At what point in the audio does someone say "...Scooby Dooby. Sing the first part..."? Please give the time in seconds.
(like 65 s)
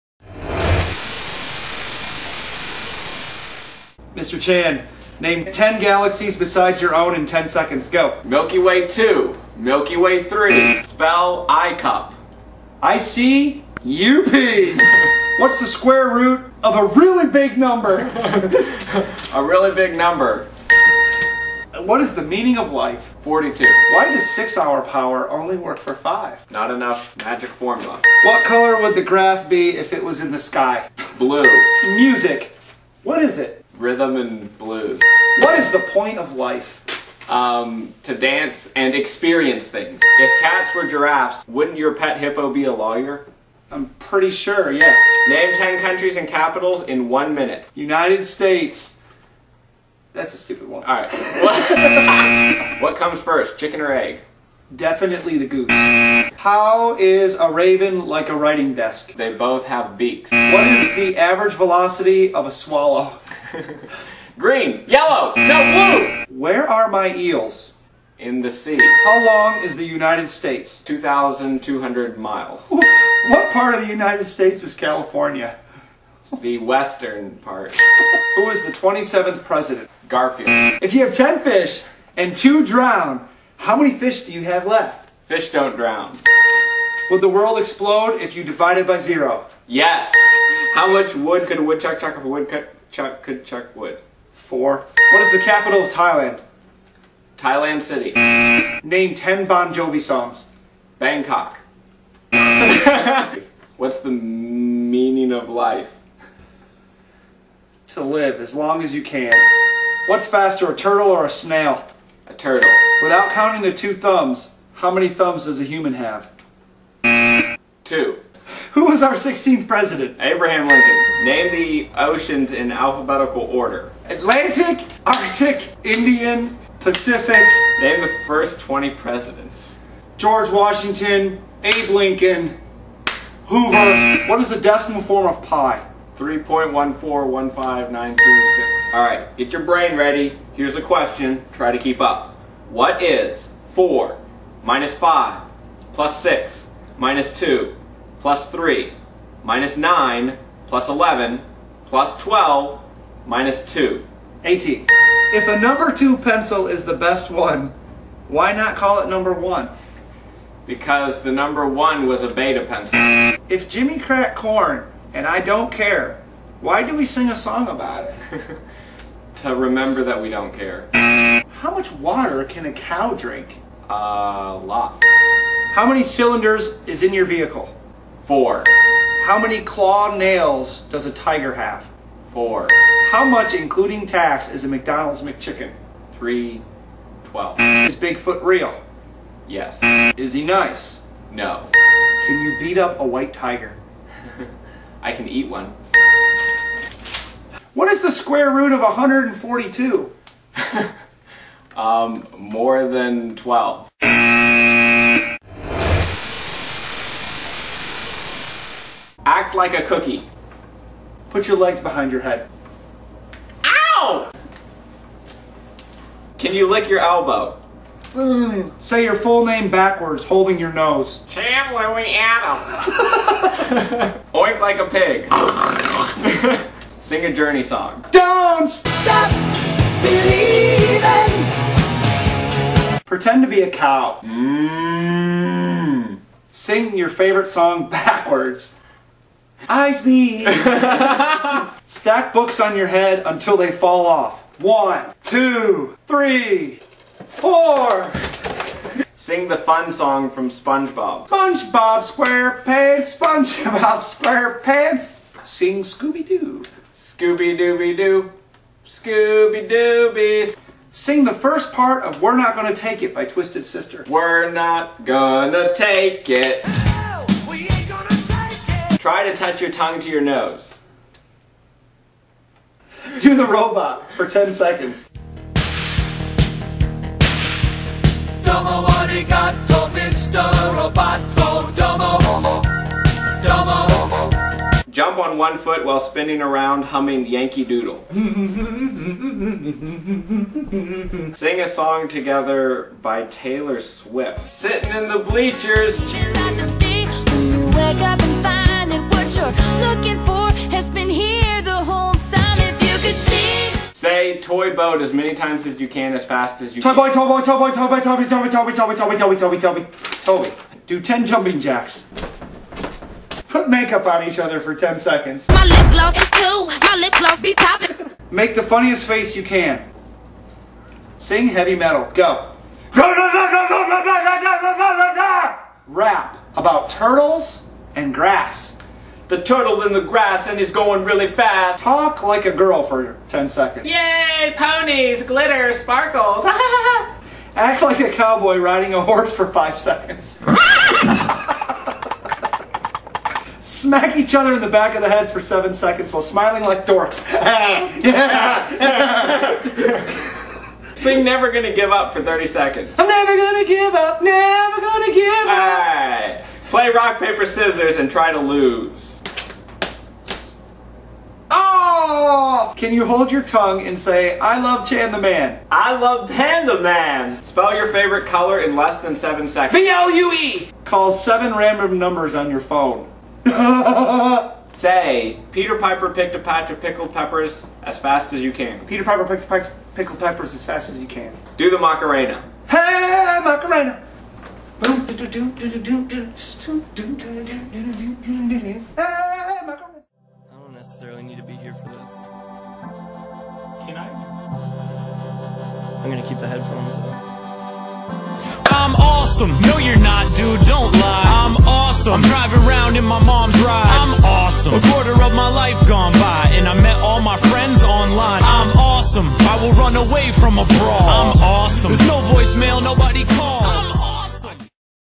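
258 s.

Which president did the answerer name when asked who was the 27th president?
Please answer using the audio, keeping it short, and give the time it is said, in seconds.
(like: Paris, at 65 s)
Garfield, at 80 s.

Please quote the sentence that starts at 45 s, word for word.
Name 10 countries and capitals in one minute.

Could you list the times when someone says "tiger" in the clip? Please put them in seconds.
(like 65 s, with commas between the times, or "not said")
181 s, 193 s.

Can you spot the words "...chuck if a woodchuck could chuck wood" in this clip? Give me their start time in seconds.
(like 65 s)
91 s.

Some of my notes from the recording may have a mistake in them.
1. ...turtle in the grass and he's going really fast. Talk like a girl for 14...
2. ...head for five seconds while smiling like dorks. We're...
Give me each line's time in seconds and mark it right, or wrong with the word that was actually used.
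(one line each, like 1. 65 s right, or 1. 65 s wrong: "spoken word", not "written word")
1. 329 s wrong: "10", not "14"
2. 345 s wrong: "seven", not "five".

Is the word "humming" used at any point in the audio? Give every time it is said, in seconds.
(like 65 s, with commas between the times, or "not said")
286 s.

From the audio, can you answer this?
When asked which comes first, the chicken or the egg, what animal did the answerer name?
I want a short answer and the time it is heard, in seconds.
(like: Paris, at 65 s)
the goose, at 55 s.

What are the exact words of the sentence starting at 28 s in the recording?
What color would the grass be if it was in the sky?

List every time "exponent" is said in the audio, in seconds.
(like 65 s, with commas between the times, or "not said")
not said.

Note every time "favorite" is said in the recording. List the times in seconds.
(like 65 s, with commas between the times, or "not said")
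237 s, 367 s.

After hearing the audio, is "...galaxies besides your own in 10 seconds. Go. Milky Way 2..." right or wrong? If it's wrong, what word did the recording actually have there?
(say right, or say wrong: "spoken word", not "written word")
right.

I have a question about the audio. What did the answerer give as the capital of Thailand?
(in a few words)
Thailand City.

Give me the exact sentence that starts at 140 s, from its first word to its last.
Here's a question, try to keep up.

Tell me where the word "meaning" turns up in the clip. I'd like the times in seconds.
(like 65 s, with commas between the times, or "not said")
22 s, 104 s.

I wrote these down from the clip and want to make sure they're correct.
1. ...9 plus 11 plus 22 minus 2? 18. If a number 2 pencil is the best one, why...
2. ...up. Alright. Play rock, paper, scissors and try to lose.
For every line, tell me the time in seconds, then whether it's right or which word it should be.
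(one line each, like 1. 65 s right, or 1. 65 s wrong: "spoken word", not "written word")
1. 149 s wrong: "12", not "22"
2. 355 s right.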